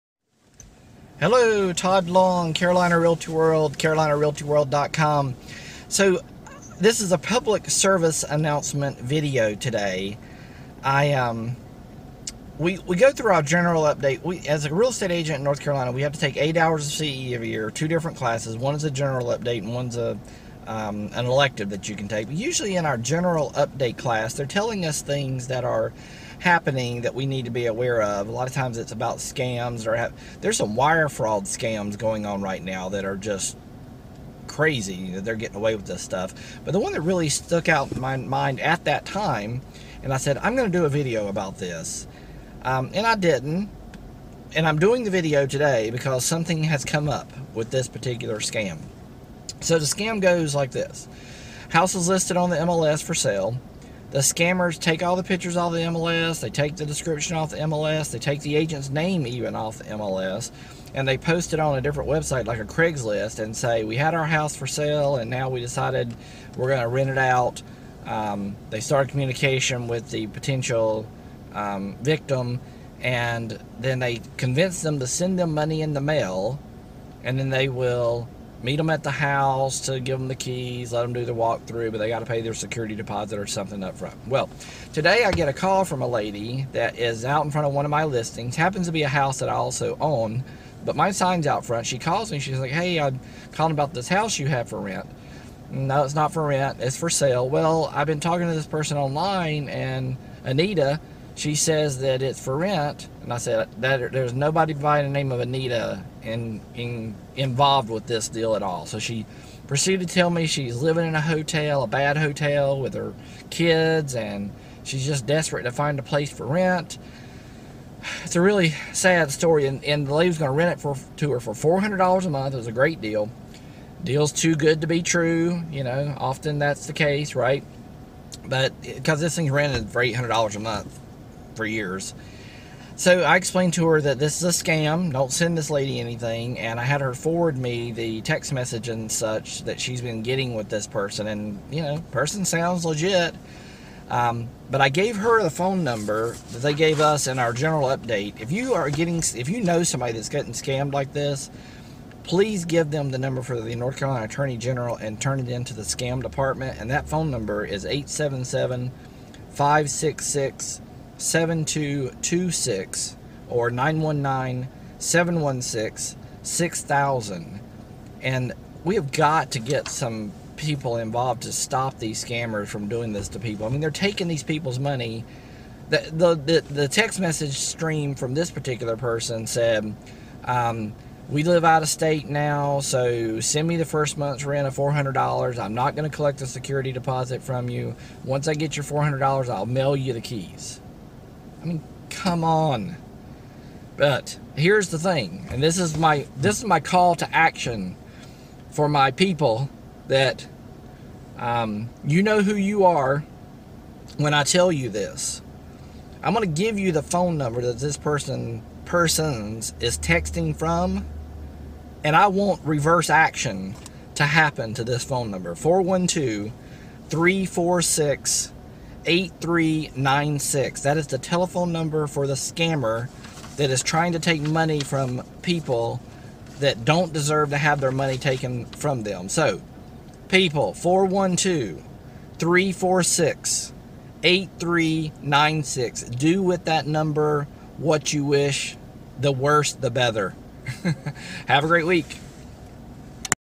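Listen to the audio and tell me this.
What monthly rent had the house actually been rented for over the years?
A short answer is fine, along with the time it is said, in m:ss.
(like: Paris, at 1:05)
$800, at 2:10.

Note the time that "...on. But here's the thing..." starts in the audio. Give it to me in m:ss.
3:12.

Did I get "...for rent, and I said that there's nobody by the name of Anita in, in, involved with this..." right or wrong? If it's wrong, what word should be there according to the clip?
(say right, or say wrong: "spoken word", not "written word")
right.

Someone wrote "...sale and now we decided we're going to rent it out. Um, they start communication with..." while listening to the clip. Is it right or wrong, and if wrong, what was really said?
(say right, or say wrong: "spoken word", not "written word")
right.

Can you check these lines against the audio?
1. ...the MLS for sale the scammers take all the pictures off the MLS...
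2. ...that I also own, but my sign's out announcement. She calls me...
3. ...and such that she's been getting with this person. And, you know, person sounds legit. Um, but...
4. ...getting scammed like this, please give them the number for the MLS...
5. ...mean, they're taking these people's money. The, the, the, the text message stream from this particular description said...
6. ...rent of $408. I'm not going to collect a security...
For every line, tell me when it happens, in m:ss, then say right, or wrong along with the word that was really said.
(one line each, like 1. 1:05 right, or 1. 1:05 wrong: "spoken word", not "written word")
1. 0:52 right
2. 1:29 wrong: "front", not "announcement"
3. 2:18 right
4. 2:30 wrong: "North", not "MLS"
5. 2:53 wrong: "person", not "description"
6. 3:04 wrong: "400", not "408".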